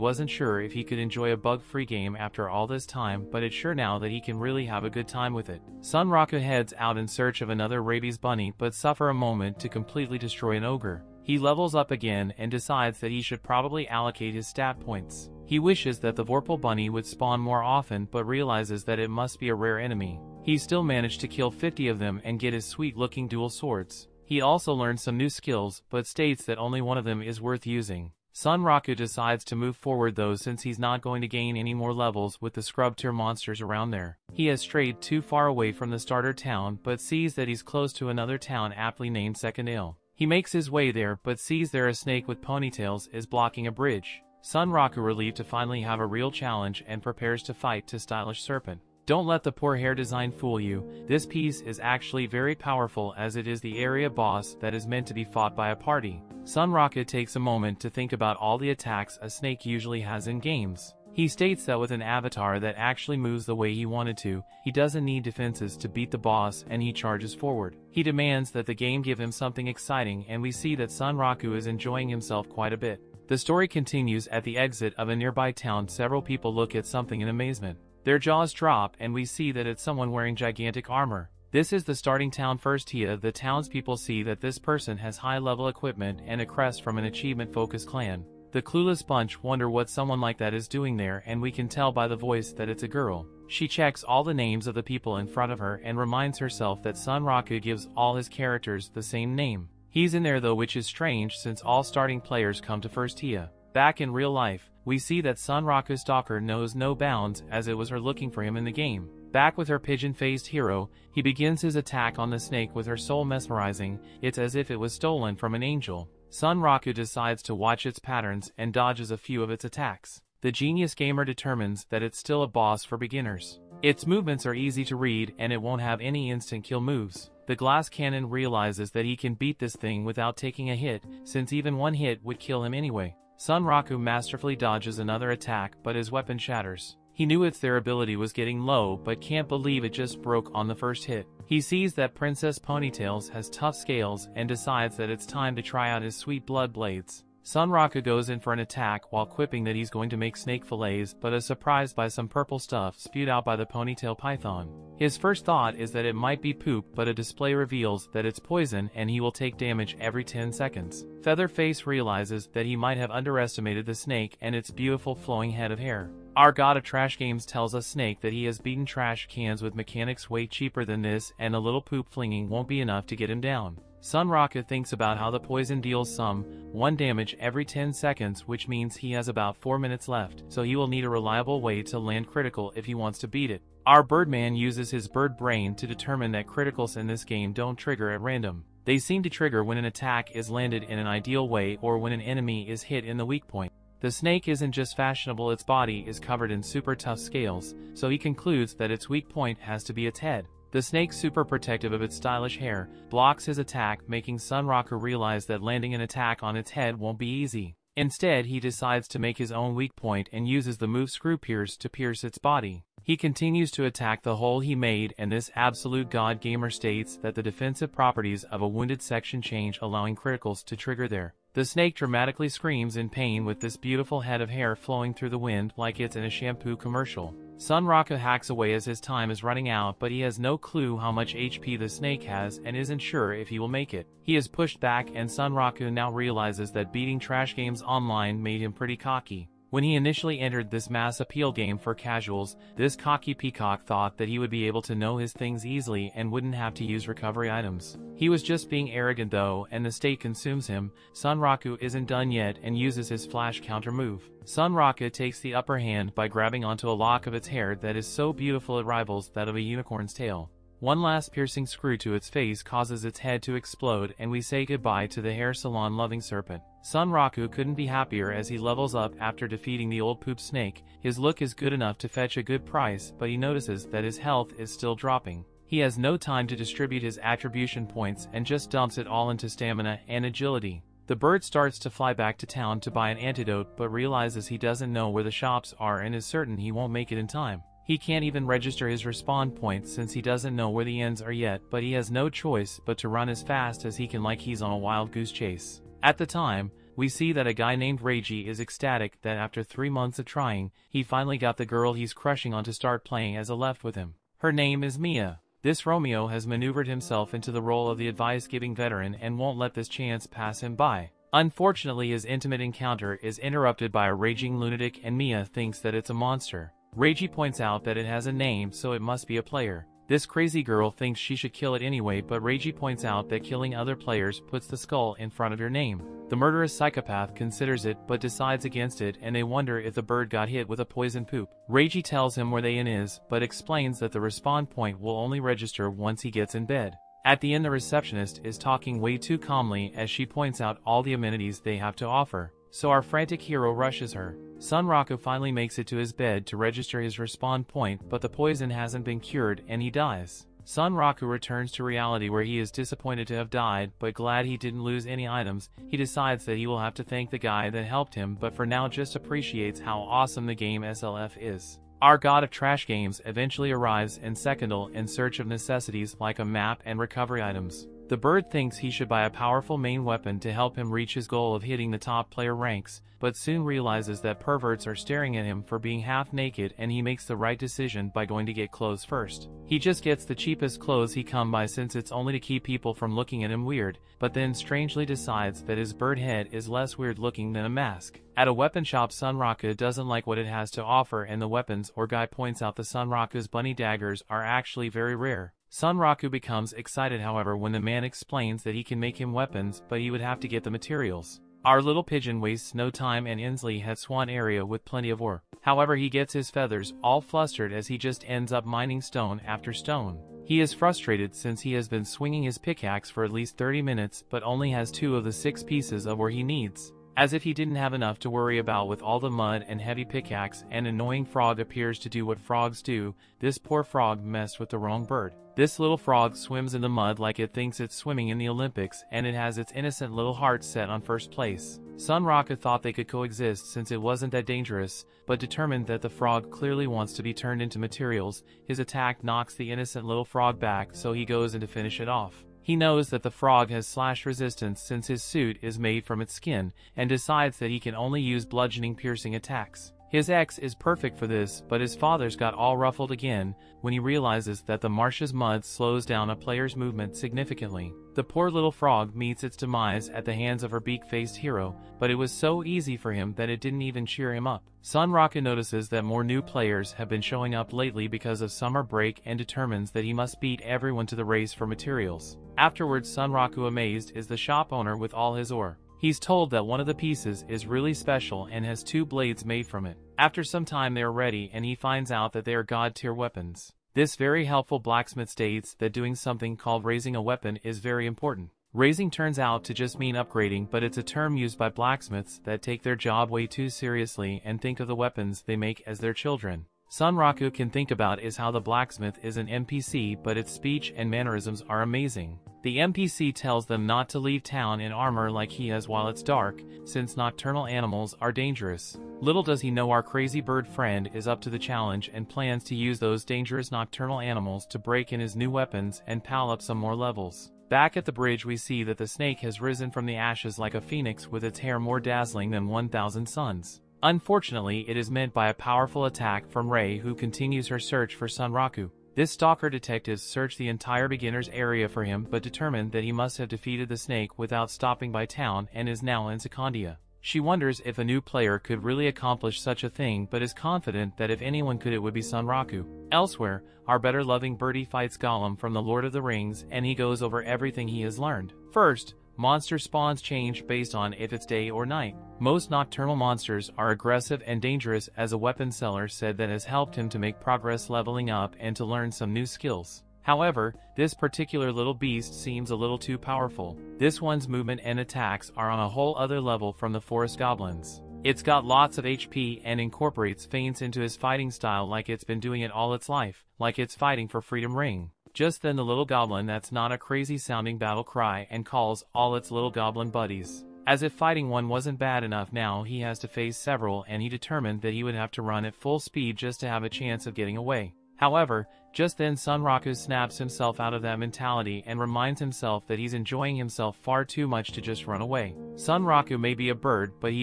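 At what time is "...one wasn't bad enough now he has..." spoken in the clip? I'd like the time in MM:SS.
09:41.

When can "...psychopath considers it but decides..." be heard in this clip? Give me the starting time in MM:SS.
05:26.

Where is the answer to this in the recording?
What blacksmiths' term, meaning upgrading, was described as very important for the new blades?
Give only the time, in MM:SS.
08:06.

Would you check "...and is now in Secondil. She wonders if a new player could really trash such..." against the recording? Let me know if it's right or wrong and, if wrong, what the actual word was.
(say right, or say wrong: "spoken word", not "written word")
wrong: "accomplish", not "trash".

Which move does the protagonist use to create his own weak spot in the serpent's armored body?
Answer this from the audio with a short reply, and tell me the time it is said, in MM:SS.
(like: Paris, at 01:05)
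Screw Pierce, at 03:31.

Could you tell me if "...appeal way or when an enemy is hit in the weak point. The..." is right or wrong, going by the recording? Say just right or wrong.
wrong.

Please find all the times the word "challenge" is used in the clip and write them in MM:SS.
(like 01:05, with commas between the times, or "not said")
00:46, 08:31.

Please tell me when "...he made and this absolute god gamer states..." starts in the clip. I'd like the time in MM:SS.
03:34.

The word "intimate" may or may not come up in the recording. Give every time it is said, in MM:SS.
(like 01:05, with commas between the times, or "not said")
05:12.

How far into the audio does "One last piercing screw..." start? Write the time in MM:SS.
04:20.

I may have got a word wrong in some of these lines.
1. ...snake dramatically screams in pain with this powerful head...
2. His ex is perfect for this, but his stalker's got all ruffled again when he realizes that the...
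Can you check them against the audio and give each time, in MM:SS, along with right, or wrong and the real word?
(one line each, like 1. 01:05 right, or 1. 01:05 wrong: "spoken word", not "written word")
1. 03:41 wrong: "beautiful", not "powerful"
2. 07:30 wrong: "father", not "stalker".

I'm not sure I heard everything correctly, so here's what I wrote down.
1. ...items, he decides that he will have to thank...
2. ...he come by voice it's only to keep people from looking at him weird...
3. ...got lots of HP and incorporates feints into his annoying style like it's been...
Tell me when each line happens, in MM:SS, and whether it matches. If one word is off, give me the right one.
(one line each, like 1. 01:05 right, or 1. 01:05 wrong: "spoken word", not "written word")
1. 05:55 right
2. 06:21 wrong: "since", not "voice"
3. 09:28 wrong: "fighting", not "annoying".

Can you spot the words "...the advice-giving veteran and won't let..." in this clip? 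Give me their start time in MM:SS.
05:07.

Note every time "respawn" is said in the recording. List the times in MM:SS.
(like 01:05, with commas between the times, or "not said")
04:49, 05:34, 05:47.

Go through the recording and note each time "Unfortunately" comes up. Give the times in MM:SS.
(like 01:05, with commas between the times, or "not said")
05:11, 08:44.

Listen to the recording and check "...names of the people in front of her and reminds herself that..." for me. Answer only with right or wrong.
right.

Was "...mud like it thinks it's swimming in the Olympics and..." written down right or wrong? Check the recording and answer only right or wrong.
right.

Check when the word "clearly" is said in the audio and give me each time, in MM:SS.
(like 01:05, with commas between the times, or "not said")
07:16.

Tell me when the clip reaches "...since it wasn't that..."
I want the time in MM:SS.
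07:13.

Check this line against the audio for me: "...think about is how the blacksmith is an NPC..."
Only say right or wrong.
right.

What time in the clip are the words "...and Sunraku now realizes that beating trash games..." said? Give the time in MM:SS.
03:55.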